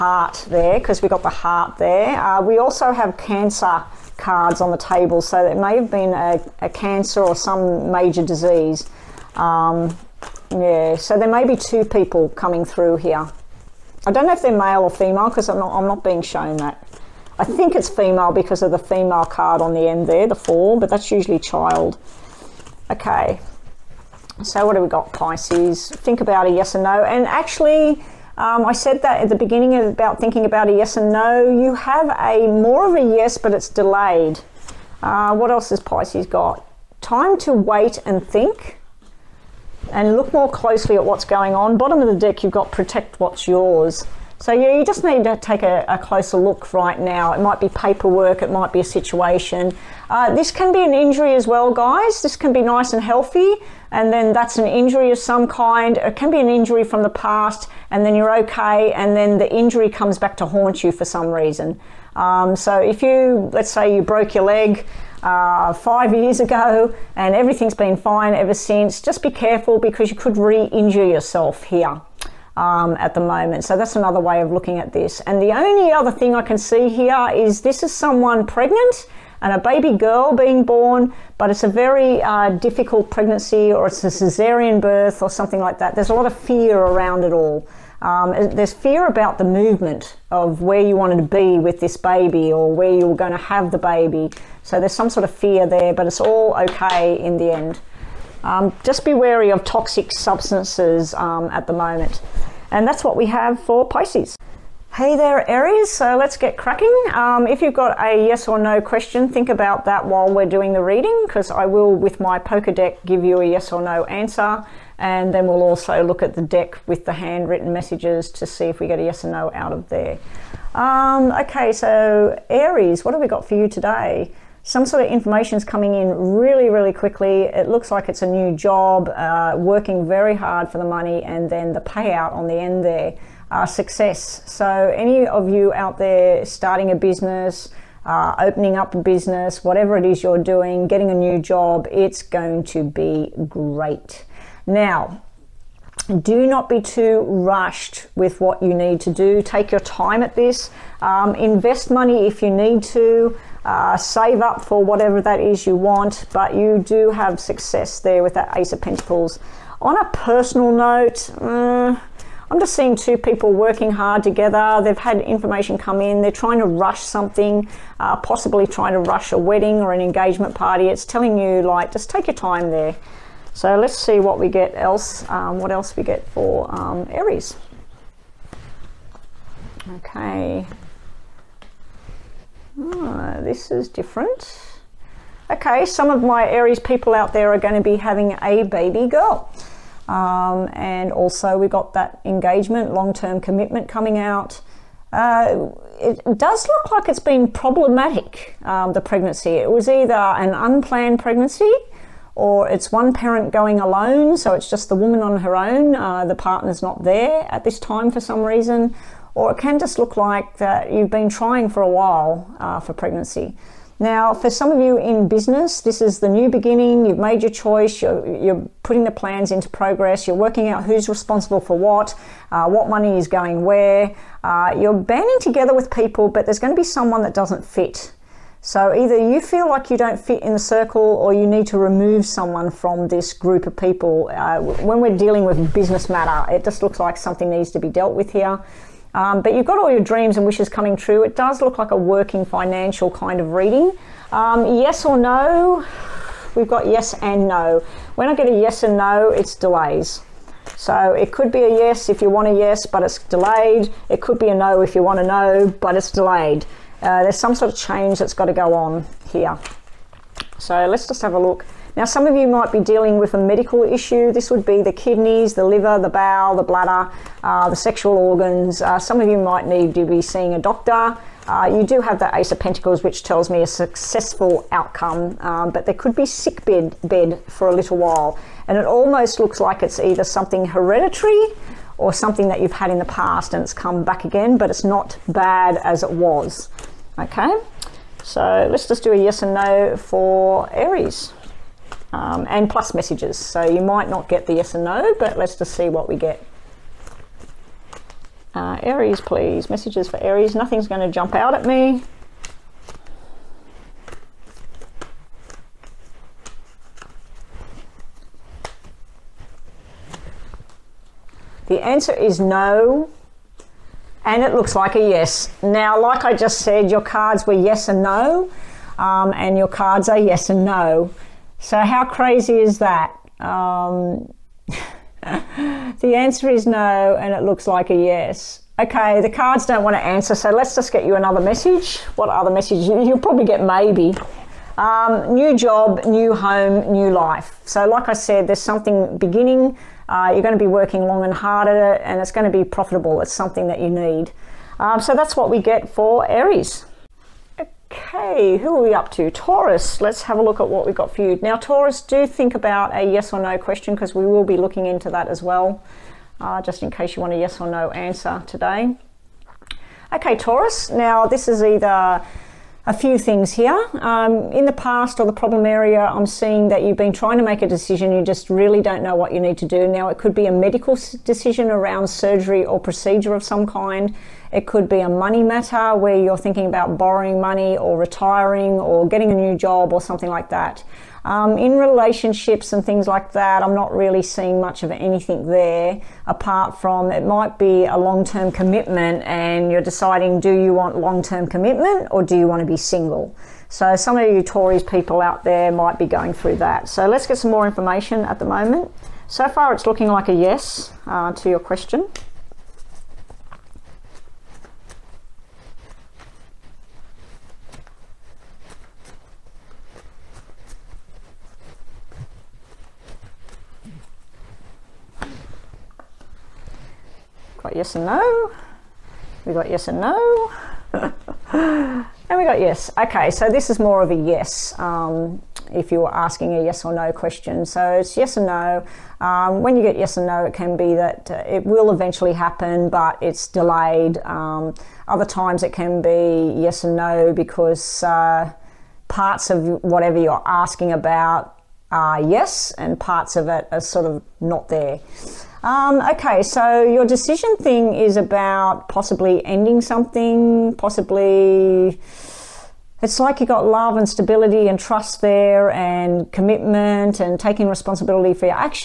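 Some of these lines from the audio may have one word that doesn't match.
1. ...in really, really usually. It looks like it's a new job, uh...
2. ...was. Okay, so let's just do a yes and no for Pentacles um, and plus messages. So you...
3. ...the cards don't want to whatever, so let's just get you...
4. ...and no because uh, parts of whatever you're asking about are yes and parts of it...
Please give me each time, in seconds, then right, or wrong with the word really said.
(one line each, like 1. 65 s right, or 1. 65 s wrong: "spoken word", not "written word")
1. 125 s wrong: "quickly", not "usually"
2. 286 s wrong: "Aries", not "Pentacles"
3. 329 s wrong: "answer", not "whatever"
4. 436 s right.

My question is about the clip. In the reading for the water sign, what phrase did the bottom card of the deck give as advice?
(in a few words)
Protect what's yours.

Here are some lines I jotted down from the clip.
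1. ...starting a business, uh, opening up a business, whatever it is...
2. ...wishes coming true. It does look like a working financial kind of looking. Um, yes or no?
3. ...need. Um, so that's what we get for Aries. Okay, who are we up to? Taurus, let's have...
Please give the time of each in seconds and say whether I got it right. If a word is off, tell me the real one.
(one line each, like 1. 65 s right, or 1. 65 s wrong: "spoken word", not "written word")
1. 136 s right
2. 240 s wrong: "reading", not "looking"
3. 343 s right.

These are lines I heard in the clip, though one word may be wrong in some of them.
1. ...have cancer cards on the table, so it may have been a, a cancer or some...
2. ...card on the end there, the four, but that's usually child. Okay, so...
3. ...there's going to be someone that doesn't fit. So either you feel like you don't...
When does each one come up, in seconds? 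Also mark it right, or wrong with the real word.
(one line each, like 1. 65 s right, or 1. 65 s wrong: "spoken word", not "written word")
1. 2 s right
2. 19 s right
3. 226 s right.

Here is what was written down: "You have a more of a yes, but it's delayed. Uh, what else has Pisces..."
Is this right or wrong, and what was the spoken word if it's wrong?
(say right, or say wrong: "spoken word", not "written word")
right.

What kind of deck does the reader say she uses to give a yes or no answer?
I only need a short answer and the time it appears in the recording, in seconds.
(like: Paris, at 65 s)
Poker deck, at 112 s.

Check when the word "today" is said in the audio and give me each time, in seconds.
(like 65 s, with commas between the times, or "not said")
123 s, 358 s.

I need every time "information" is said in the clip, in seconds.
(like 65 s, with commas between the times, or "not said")
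125 s, 165 s, 397 s.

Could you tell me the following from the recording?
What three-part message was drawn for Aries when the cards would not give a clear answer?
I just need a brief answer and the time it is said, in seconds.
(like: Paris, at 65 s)
New job, new home, new life, at 335 s.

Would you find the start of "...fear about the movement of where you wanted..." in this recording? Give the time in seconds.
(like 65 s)
88 s.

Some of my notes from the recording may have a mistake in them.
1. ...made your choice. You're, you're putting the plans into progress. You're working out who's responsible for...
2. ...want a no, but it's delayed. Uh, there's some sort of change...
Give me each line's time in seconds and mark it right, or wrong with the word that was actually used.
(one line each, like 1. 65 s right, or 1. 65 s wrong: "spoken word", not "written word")
1. 217 s right
2. 255 s right.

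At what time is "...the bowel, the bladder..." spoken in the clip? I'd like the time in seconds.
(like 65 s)
265 s.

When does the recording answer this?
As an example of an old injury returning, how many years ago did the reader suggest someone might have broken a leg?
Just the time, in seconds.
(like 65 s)
65 s.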